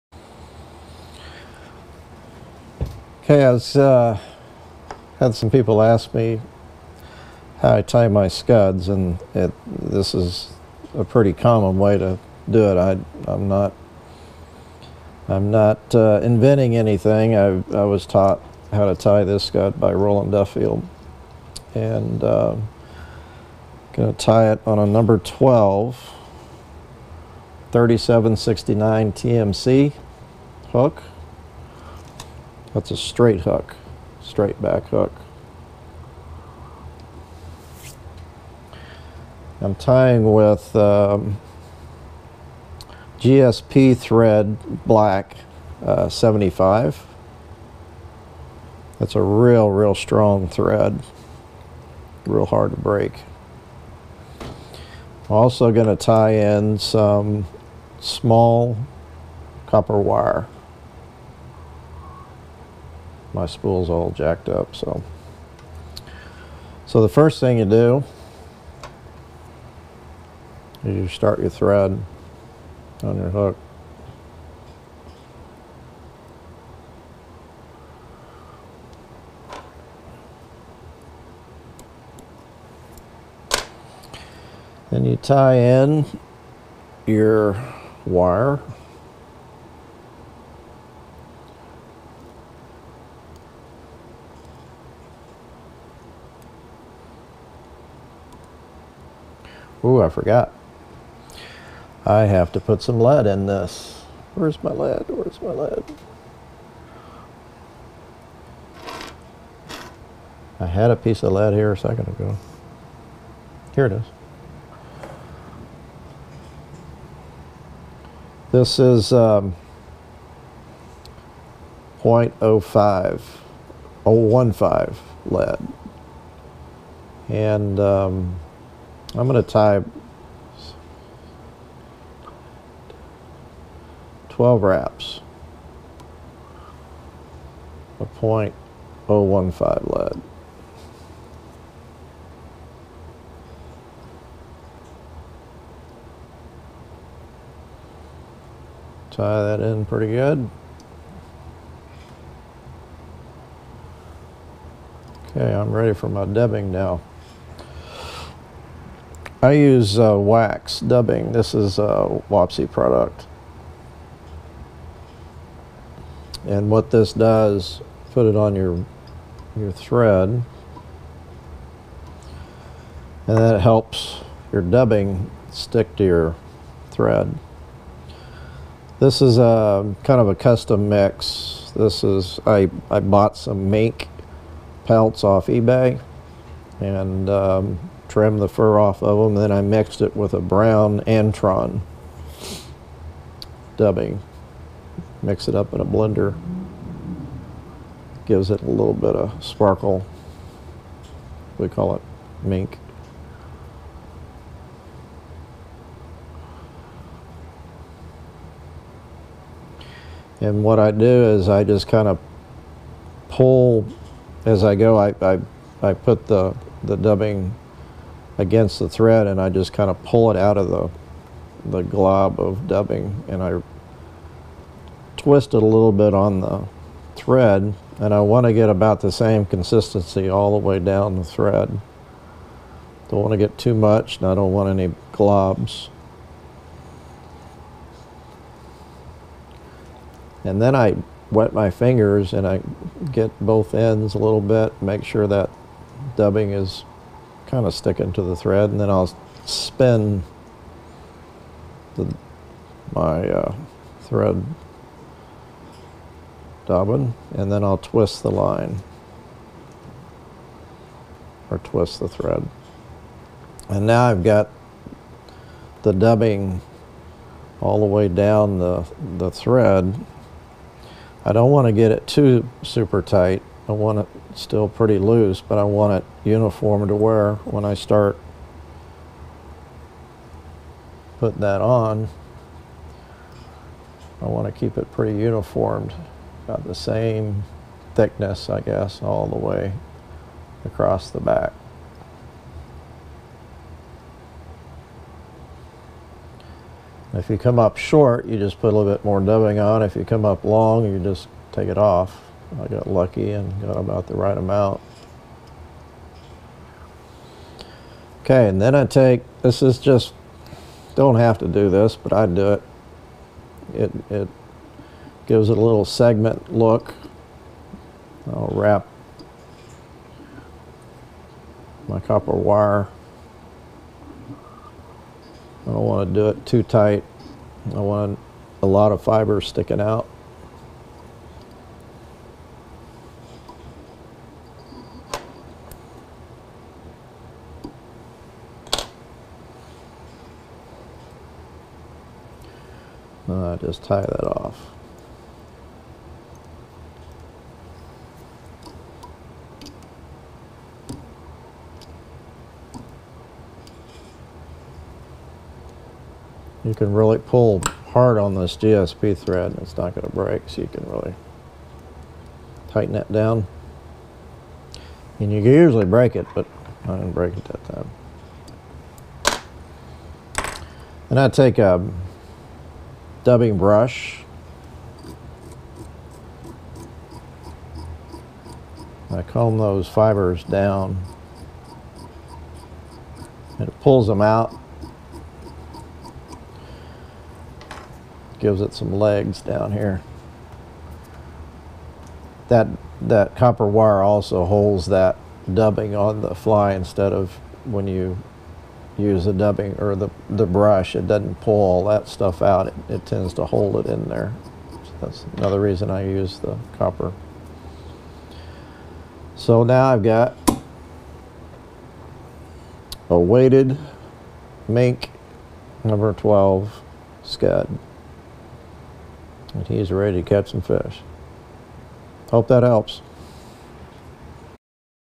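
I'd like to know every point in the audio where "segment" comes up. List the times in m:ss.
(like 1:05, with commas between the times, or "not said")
5:15.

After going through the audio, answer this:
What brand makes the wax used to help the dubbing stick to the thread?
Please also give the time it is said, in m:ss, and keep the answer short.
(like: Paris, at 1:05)
Wapsi, at 2:42.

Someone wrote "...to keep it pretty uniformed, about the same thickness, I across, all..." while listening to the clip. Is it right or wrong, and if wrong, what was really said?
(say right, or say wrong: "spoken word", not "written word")
wrong: "guess", not "across".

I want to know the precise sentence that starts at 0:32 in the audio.
That's a straight hook, straight back hook.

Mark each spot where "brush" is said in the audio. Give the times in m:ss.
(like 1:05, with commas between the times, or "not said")
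6:13, 6:40.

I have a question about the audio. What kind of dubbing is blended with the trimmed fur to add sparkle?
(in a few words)
brown Antron dubbing.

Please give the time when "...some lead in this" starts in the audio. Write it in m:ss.
1:42.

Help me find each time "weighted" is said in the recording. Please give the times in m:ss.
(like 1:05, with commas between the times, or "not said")
6:53.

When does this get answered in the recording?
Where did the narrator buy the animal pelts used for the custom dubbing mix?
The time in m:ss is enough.
3:05.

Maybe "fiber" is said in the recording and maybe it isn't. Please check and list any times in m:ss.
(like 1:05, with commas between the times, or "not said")
5:29, 6:19.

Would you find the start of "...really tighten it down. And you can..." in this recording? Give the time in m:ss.
6:00.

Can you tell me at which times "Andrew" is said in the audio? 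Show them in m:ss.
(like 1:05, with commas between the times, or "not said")
not said.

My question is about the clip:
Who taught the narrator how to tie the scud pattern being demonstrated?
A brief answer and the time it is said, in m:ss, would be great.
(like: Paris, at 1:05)
Roland Duffield, at 0:19.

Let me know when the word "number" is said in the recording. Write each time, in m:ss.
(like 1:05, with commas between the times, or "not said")
0:24, 6:55.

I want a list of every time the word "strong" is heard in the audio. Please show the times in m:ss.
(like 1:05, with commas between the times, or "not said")
0:49.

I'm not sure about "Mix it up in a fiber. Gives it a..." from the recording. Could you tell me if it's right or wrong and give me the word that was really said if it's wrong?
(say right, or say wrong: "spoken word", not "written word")
wrong: "blender", not "fiber".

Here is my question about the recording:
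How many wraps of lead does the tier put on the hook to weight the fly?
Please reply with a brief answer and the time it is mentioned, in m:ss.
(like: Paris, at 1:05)
12, at 2:14.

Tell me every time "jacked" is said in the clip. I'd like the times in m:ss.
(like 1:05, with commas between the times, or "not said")
1:04.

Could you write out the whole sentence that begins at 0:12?
I, am not I'm not uh, inventing anything.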